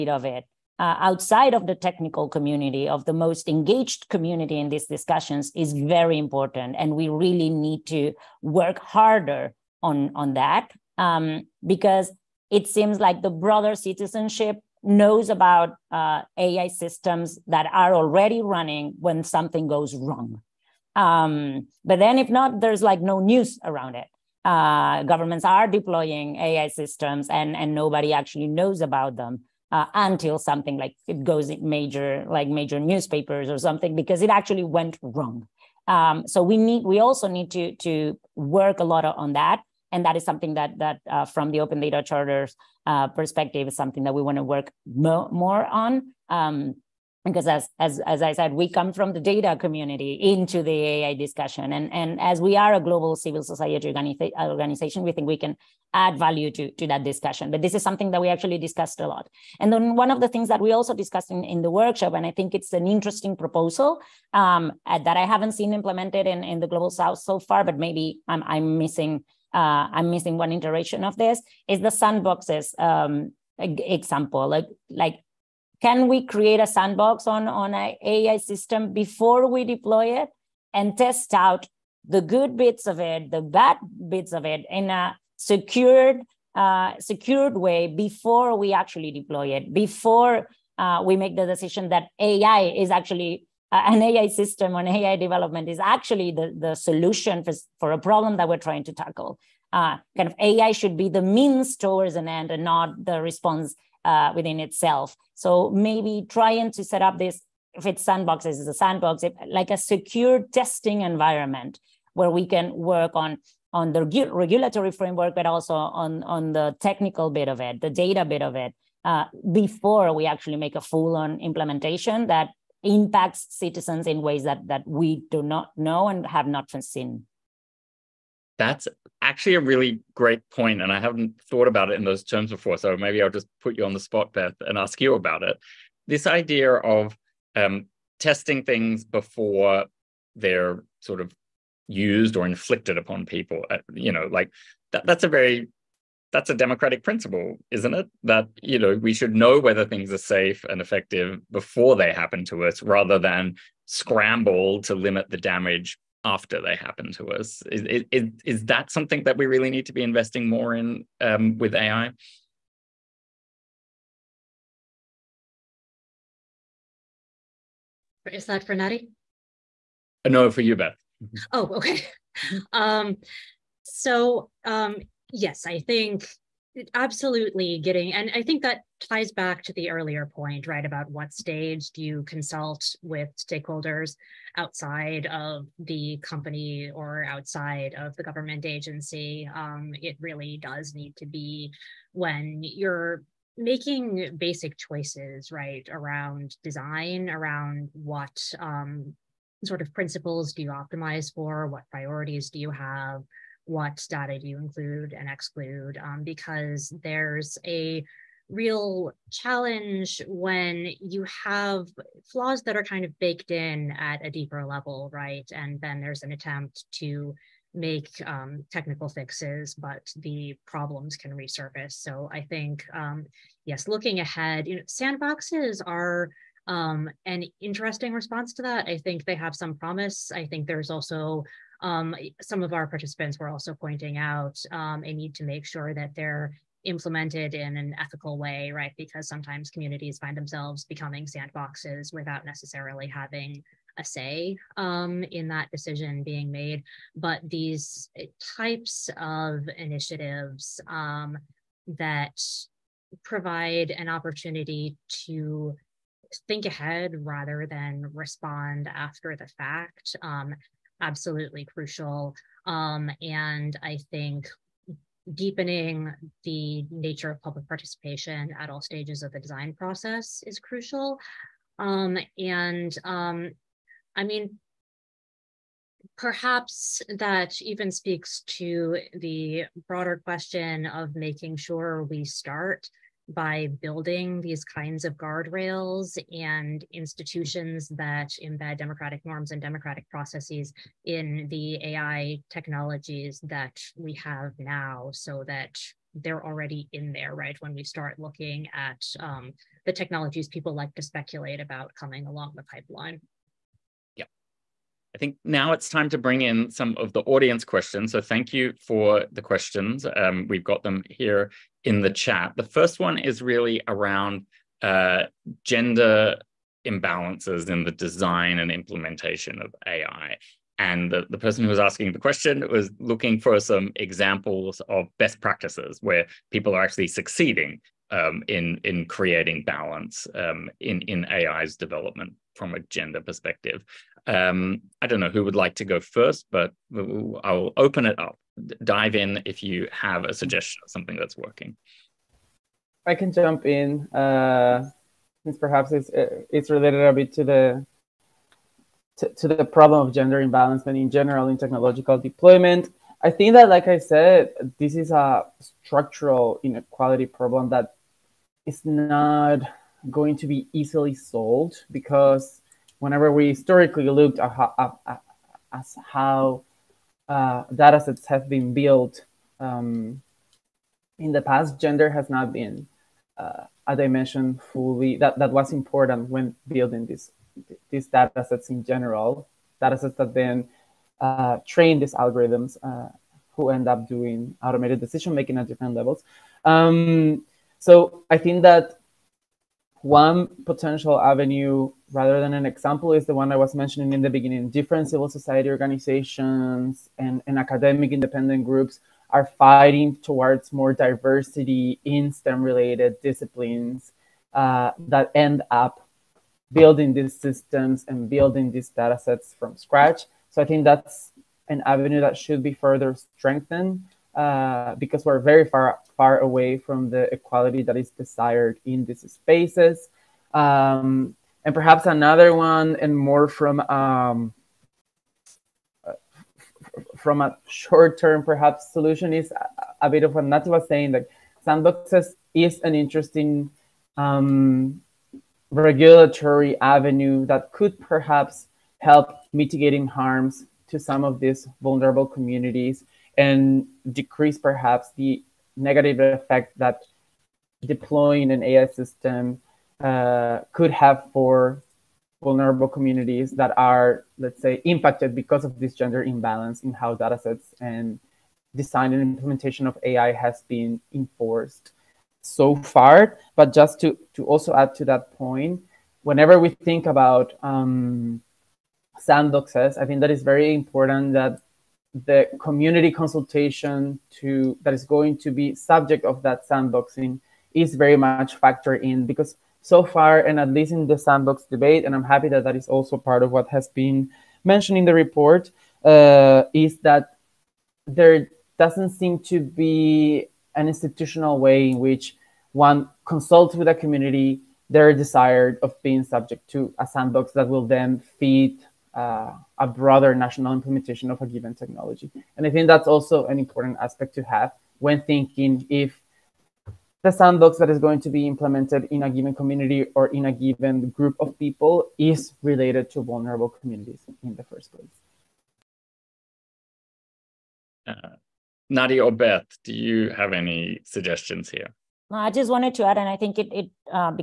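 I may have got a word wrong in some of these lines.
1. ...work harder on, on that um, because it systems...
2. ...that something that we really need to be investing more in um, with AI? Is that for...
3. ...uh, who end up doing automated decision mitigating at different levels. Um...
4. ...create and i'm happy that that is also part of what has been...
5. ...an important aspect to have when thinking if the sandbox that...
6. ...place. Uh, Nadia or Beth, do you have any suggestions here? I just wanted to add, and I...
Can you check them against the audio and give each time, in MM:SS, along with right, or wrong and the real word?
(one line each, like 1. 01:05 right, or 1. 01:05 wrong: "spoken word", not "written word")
1. 00:08 wrong: "seems", not "systems"
2. 02:38 right
3. 06:22 wrong: "making", not "mitigating"
4. 08:01 wrong: "debate", not "create"
5. 08:23 right
6. 08:34 right.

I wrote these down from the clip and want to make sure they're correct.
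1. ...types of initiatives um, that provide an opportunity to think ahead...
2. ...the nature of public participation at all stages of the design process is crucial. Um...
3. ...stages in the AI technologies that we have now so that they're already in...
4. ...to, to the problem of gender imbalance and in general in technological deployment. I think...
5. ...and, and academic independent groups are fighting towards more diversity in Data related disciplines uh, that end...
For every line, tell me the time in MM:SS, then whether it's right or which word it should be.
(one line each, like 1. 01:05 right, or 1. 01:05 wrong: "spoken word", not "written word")
1. 04:08 right
2. 04:26 right
3. 04:50 wrong: "processes", not "stages"
4. 05:49 right
5. 06:37 wrong: "STEM", not "Data".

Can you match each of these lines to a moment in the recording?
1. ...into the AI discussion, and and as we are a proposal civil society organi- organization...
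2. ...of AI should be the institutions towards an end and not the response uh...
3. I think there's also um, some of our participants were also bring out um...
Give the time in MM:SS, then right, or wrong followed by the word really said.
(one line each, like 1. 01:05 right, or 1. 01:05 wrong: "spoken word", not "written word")
1. 00:50 wrong: "global", not "proposal"
2. 01:40 wrong: "means", not "institutions"
3. 03:50 wrong: "pointing", not "bring".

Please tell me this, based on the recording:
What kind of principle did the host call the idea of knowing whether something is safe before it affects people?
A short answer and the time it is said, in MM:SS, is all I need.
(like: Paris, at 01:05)
democratic principle, at 02:26.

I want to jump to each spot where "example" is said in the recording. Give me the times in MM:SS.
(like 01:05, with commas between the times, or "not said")
01:13, 05:23, 06:32.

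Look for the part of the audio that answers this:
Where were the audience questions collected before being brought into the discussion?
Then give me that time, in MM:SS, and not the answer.
05:12.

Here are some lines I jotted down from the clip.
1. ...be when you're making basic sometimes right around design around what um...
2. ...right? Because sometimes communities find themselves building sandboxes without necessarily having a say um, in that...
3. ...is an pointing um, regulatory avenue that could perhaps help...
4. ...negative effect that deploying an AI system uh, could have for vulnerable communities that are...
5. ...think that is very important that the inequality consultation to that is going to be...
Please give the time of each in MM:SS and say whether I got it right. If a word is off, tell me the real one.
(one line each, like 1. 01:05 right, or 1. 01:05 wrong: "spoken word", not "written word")
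1. 03:11 wrong: "choices", not "sometimes"
2. 03:58 wrong: "becoming", not "building"
3. 07:12 wrong: "interesting", not "pointing"
4. 07:25 right
5. 07:50 wrong: "community", not "inequality".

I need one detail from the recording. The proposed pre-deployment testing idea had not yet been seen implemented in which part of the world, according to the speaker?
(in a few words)
global south.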